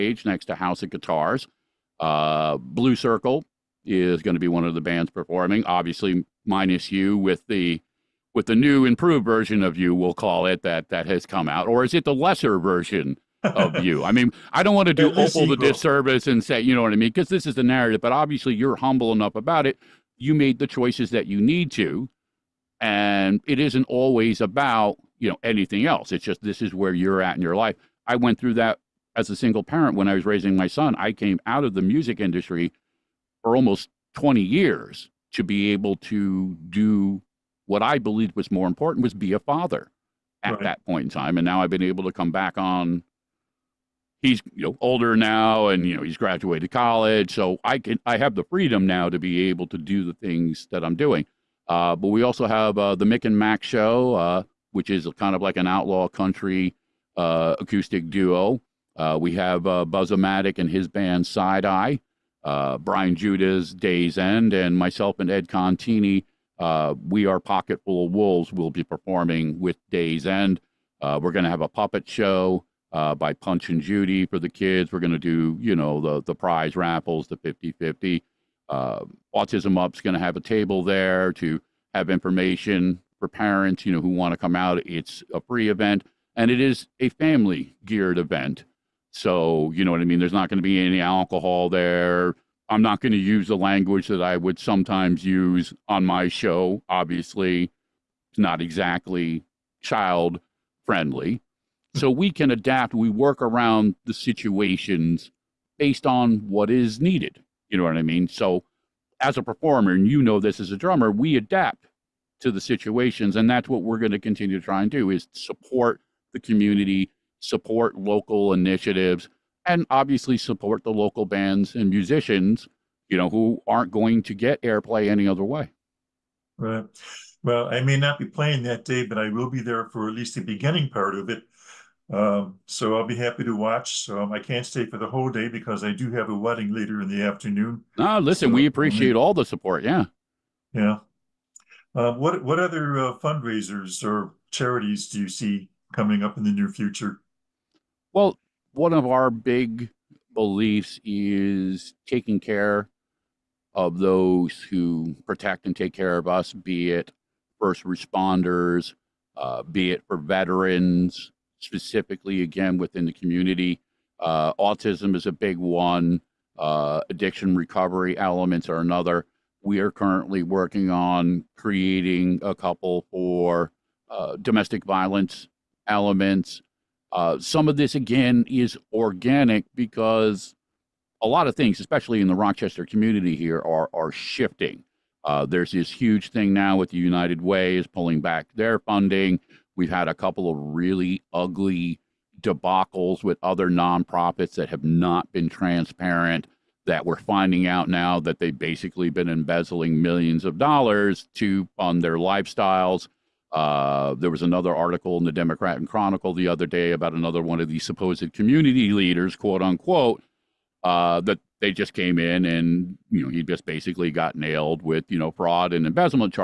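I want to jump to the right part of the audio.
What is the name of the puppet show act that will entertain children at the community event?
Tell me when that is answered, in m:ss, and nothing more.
1:13.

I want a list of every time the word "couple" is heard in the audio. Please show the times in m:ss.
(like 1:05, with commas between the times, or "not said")
2:52, 3:10.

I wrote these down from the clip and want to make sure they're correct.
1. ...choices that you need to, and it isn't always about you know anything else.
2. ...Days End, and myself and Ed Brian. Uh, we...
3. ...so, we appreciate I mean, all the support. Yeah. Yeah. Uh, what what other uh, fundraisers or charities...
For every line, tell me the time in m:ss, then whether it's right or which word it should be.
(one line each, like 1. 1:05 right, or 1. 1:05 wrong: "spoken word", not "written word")
1. 0:20 right
2. 1:03 wrong: "Contini", not "Brian"
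3. 2:18 right.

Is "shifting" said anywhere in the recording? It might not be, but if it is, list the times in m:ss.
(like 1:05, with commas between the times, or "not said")
3:04.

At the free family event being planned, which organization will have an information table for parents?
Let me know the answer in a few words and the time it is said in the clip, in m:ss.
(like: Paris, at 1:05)
Autism Up, at 1:19.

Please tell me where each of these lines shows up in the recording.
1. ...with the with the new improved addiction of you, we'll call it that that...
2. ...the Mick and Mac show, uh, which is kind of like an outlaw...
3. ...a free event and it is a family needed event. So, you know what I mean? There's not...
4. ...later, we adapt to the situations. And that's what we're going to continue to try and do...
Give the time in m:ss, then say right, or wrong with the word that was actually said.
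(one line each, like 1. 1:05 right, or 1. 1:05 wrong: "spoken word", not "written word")
1. 0:07 wrong: "version", not "addiction"
2. 0:52 right
3. 1:25 wrong: "geared", not "needed"
4. 1:50 wrong: "drummer", not "later".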